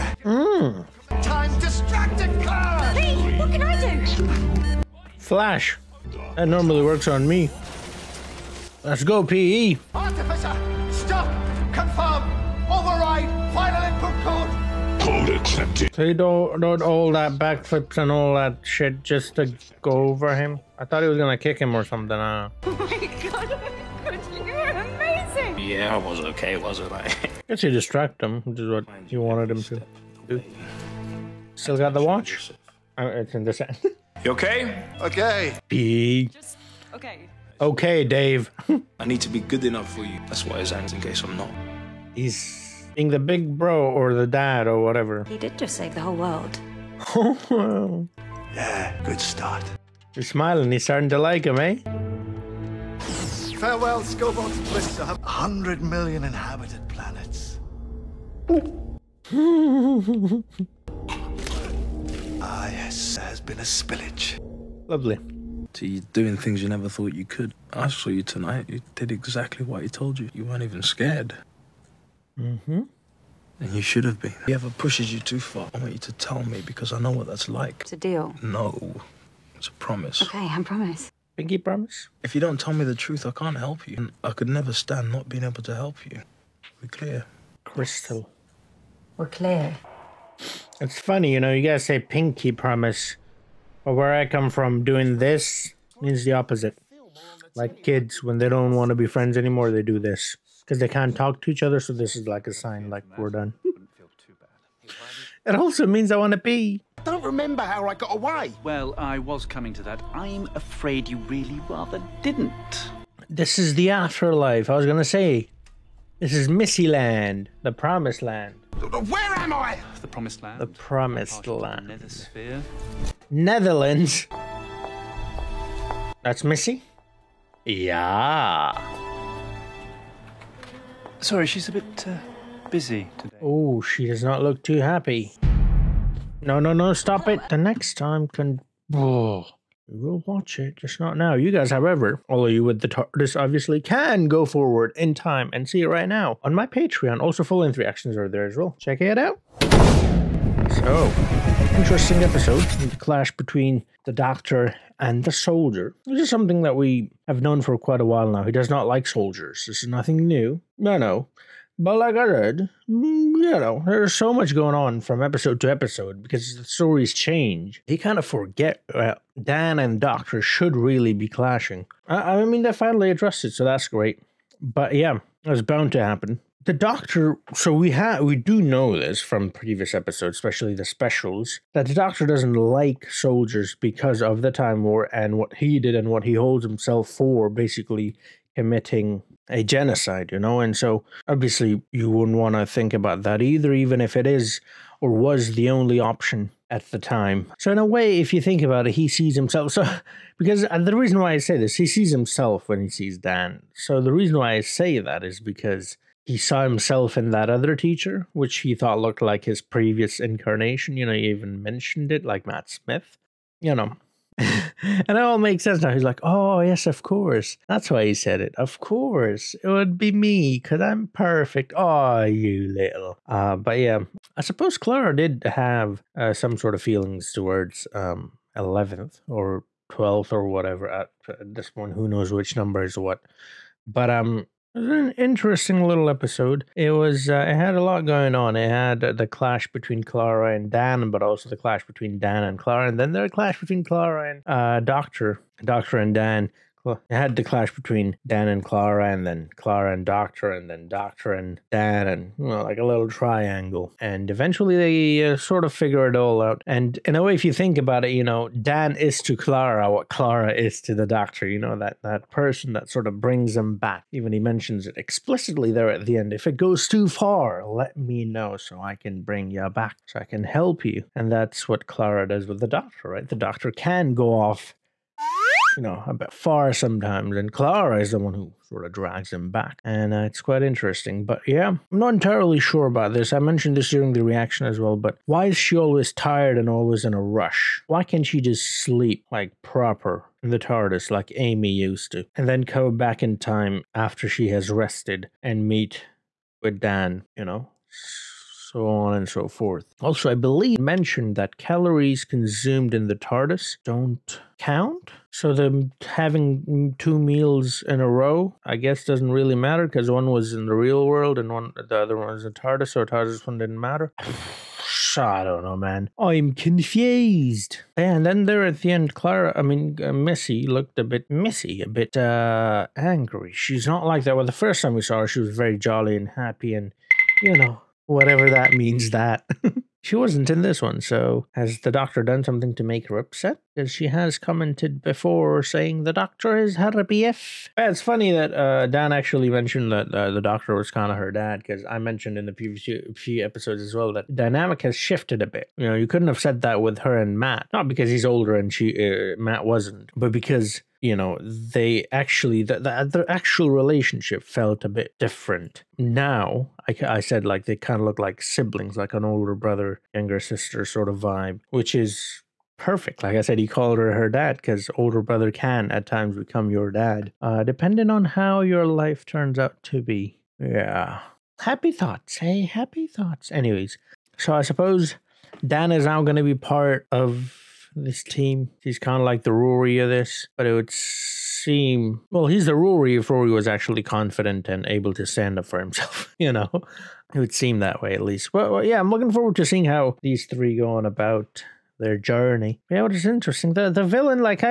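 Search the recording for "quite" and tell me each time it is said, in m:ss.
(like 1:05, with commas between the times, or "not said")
2:37, 4:40.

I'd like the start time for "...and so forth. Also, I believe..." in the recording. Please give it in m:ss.
4:59.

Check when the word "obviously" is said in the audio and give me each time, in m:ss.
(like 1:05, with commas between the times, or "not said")
2:23, 3:11.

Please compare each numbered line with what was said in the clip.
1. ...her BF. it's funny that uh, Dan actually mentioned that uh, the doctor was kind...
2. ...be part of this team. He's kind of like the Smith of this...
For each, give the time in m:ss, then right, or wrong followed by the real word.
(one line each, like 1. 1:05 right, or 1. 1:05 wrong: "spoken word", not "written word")
1. 5:36 right
2. 6:16 wrong: "Rory", not "Smith".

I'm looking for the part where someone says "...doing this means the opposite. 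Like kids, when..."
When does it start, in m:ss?
1:34.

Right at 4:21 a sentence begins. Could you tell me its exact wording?
You know that that person that sort of brings him back.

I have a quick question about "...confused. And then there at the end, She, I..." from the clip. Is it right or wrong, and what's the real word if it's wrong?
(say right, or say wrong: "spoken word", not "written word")
wrong: "Clara", not "She".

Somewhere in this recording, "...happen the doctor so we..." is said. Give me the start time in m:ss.
2:56.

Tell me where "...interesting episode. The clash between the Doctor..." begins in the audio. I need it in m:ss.
2:31.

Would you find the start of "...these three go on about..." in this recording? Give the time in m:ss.
6:30.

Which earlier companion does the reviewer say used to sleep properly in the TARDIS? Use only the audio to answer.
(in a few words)
Amy.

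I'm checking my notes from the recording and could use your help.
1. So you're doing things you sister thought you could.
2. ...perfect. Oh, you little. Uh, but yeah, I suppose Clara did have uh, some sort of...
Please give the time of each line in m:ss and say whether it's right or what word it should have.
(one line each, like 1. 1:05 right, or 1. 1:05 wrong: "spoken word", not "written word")
1. 1:05 wrong: "never", not "sister"
2. 3:41 right.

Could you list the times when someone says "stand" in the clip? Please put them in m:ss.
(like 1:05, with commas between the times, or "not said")
1:24, 6:25.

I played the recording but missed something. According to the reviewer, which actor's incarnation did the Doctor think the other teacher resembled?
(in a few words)
Matt Smith.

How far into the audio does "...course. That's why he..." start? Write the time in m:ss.
3:37.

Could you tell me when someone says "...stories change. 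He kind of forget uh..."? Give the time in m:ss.
2:46.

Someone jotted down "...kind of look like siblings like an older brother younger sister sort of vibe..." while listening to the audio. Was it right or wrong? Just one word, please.
right.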